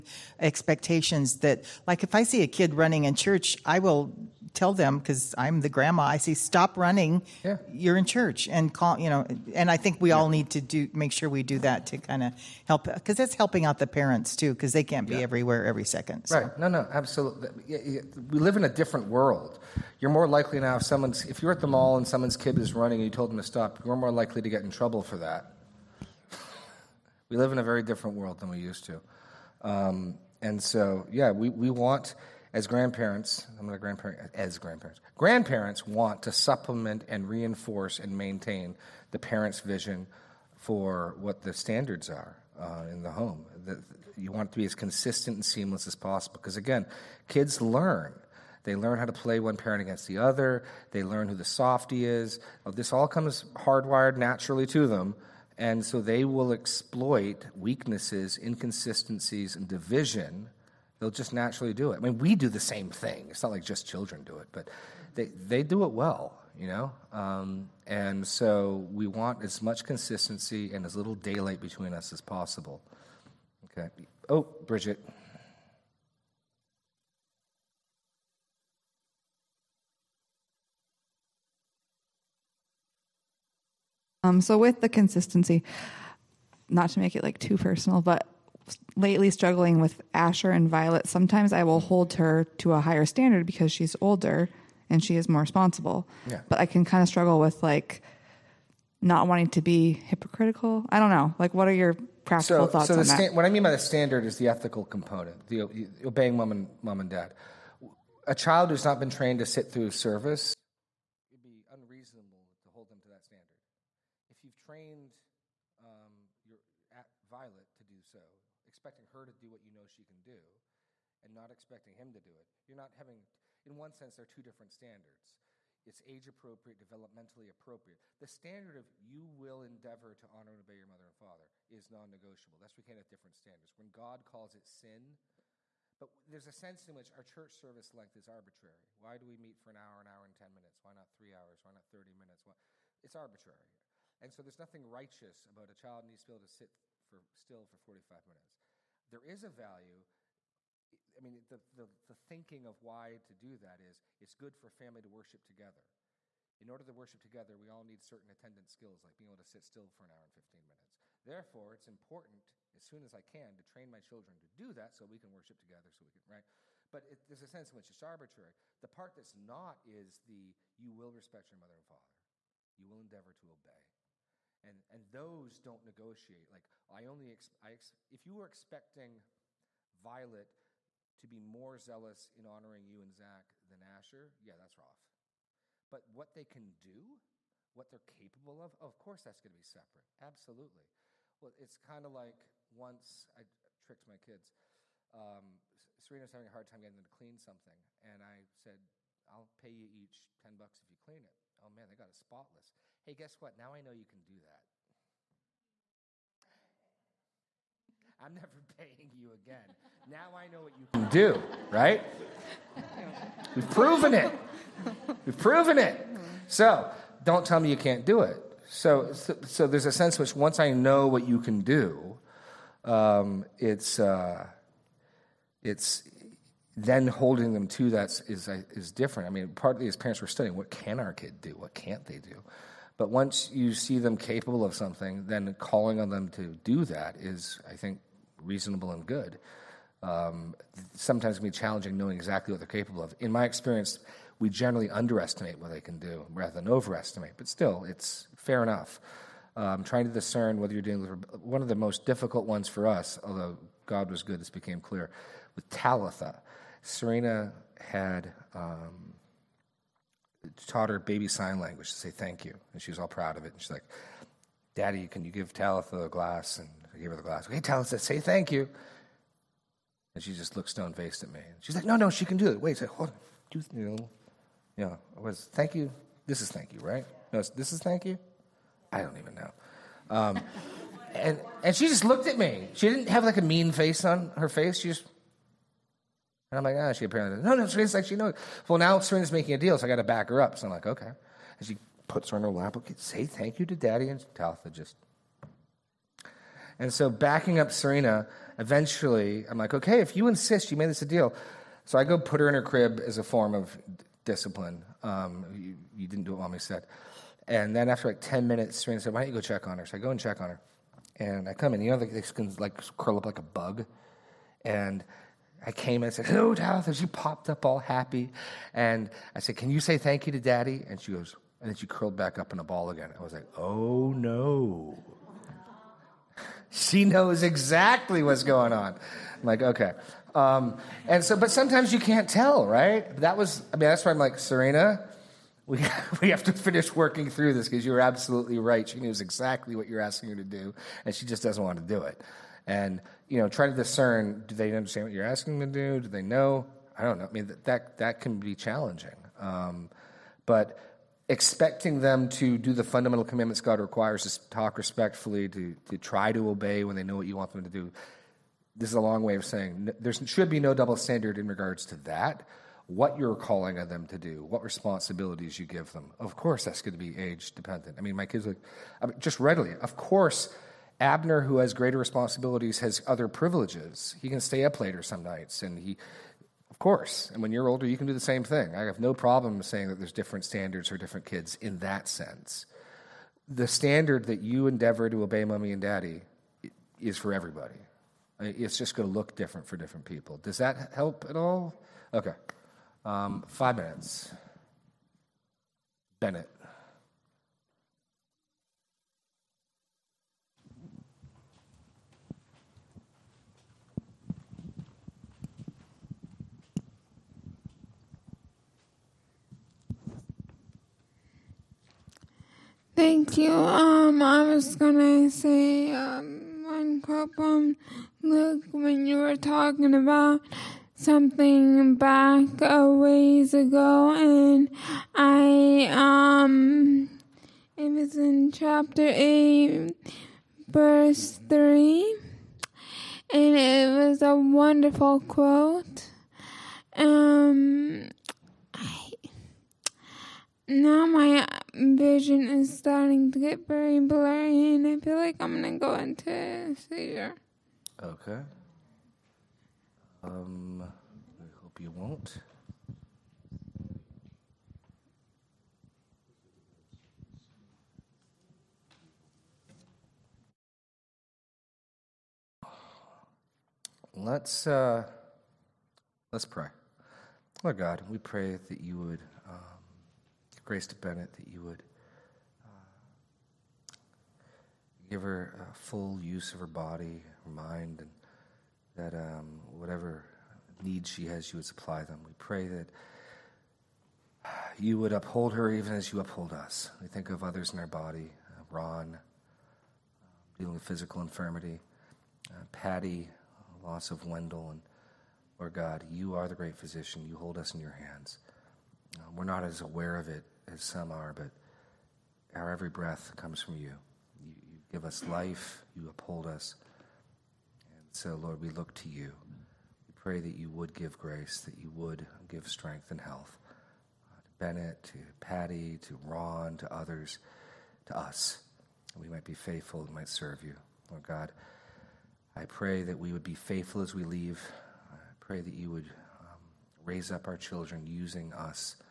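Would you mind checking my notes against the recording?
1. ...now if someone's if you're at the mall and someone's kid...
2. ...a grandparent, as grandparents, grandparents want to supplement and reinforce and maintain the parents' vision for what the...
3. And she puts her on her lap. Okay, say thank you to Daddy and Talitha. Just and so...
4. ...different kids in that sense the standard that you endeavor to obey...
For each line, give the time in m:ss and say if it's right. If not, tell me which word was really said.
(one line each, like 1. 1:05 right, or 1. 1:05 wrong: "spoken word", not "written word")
1. 0:20 right
2. 0:33 right
3. 4:51 right
4. 6:20 right.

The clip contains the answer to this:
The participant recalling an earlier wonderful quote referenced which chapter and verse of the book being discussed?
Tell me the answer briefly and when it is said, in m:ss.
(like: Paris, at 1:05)
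Chapter 8, verse 3, at 7:08.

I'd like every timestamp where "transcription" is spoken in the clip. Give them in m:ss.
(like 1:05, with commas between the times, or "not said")
not said.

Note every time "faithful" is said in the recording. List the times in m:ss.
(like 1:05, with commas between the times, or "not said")
8:39, 8:43.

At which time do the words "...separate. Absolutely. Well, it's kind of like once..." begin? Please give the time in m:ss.
3:09.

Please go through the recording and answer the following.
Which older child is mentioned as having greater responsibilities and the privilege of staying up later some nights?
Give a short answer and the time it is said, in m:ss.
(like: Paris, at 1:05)
Abner, at 6:11.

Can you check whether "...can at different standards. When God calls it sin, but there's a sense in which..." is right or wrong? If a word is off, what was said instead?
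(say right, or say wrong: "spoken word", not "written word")
right.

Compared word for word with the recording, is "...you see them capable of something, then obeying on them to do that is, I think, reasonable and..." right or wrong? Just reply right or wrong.
wrong.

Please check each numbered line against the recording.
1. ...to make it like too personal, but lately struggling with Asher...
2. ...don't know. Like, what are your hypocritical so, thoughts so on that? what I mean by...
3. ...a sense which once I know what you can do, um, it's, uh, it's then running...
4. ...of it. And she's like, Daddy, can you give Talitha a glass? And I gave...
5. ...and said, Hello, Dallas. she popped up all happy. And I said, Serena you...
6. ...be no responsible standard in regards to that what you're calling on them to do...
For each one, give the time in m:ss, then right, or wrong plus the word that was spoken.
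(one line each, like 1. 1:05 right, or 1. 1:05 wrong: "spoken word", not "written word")
1. 1:26 right
2. 1:40 wrong: "practical", not "hypocritical"
3. 3:39 wrong: "holding", not "running"
4. 4:23 right
5. 5:16 wrong: "Can", not "Serena"
6. 6:00 wrong: "double", not "responsible".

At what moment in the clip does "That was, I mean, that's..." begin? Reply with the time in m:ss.
5:33.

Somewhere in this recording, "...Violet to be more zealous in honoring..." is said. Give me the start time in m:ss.
2:59.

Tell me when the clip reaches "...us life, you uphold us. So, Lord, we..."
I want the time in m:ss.
8:25.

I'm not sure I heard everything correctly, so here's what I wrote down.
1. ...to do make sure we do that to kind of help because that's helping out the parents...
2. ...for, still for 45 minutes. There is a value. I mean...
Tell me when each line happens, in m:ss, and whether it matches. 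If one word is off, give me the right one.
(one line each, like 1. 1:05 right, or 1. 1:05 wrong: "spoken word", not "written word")
1. 0:10 right
2. 2:27 right.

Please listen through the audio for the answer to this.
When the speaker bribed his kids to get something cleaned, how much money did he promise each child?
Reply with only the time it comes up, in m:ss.
3:20.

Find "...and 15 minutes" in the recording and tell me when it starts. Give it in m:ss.
2:40.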